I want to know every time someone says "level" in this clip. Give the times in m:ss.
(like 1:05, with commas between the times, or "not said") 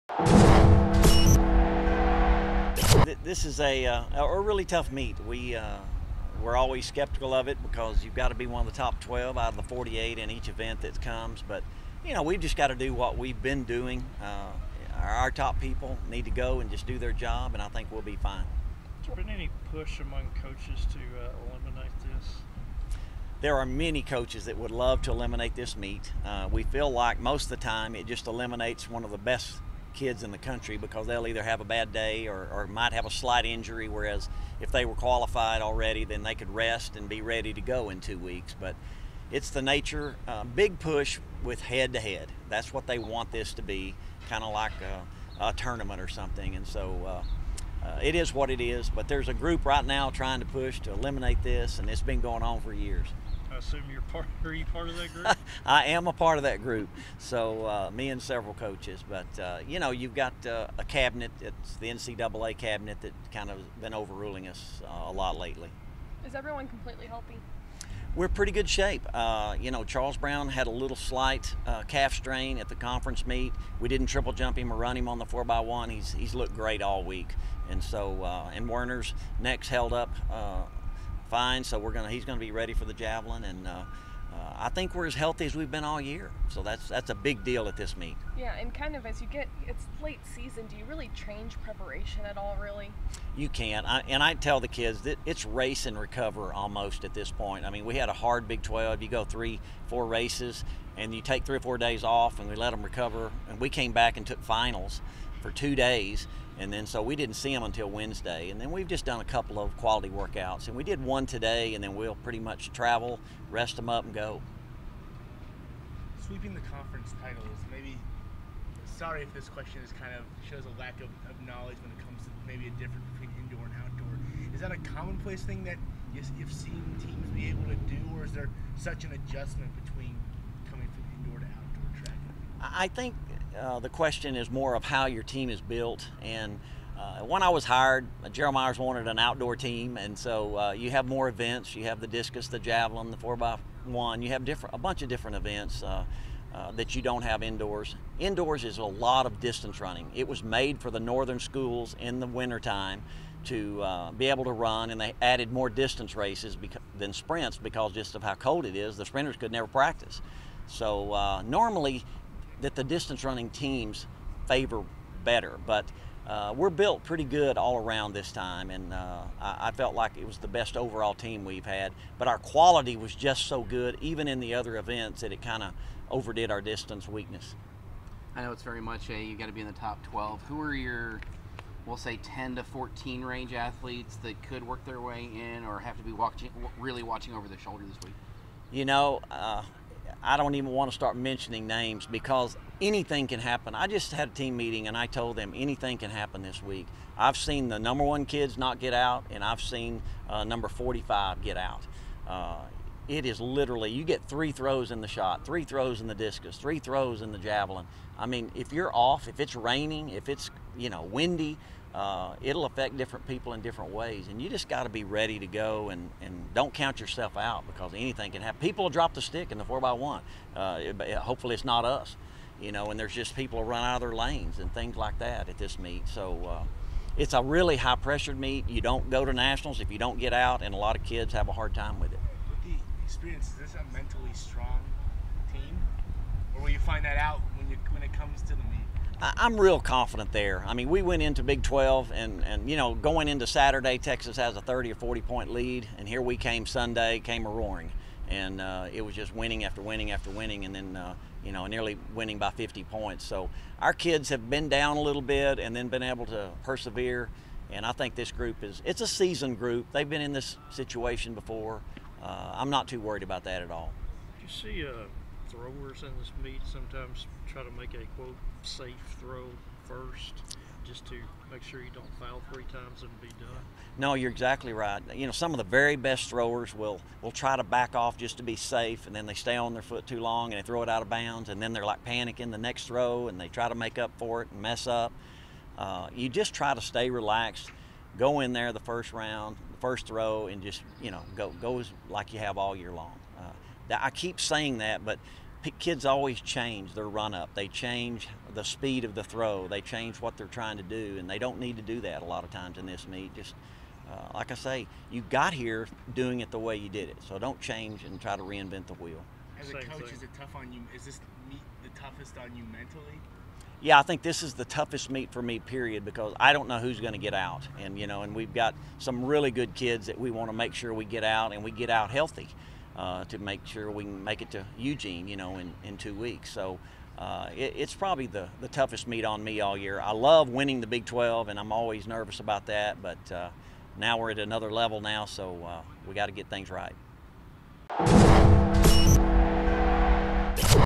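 5:34.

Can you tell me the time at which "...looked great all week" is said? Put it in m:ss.
1:16.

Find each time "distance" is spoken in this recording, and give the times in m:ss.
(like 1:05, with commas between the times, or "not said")
2:29, 2:35, 2:42, 2:56.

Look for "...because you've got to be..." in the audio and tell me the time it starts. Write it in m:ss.
0:07.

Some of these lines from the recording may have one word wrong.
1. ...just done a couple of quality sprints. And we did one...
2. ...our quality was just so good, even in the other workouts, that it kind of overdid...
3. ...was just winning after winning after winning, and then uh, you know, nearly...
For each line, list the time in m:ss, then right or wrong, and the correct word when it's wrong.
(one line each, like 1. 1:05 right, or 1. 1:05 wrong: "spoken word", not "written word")
1. 1:48 wrong: "workouts", not "sprints"
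2. 2:52 wrong: "events", not "workouts"
3. 4:09 right.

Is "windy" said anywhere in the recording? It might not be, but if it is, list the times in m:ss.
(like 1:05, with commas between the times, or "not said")
3:31.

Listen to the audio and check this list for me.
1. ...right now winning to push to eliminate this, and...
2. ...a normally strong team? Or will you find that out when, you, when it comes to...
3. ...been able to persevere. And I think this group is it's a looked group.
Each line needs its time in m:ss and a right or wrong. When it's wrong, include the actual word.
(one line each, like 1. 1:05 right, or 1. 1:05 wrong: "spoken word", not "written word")
1. 0:49 wrong: "trying", not "winning"
2. 3:53 wrong: "mentally", not "normally"
3. 4:15 wrong: "seasoned", not "looked".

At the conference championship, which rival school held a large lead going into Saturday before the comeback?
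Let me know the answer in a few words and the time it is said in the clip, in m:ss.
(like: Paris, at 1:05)
Texas, at 4:03.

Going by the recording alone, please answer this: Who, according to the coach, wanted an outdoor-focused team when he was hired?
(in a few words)
Gerald Myers.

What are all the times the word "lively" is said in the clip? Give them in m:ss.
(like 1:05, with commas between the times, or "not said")
not said.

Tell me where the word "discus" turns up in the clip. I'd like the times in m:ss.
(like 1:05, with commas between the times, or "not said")
2:22, 3:26.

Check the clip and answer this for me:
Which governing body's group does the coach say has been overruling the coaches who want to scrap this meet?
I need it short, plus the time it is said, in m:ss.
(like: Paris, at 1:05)
NCAA cabinet, at 1:01.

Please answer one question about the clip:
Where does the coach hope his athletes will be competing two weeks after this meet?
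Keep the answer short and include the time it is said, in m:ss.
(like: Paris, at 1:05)
Eugene, at 5:24.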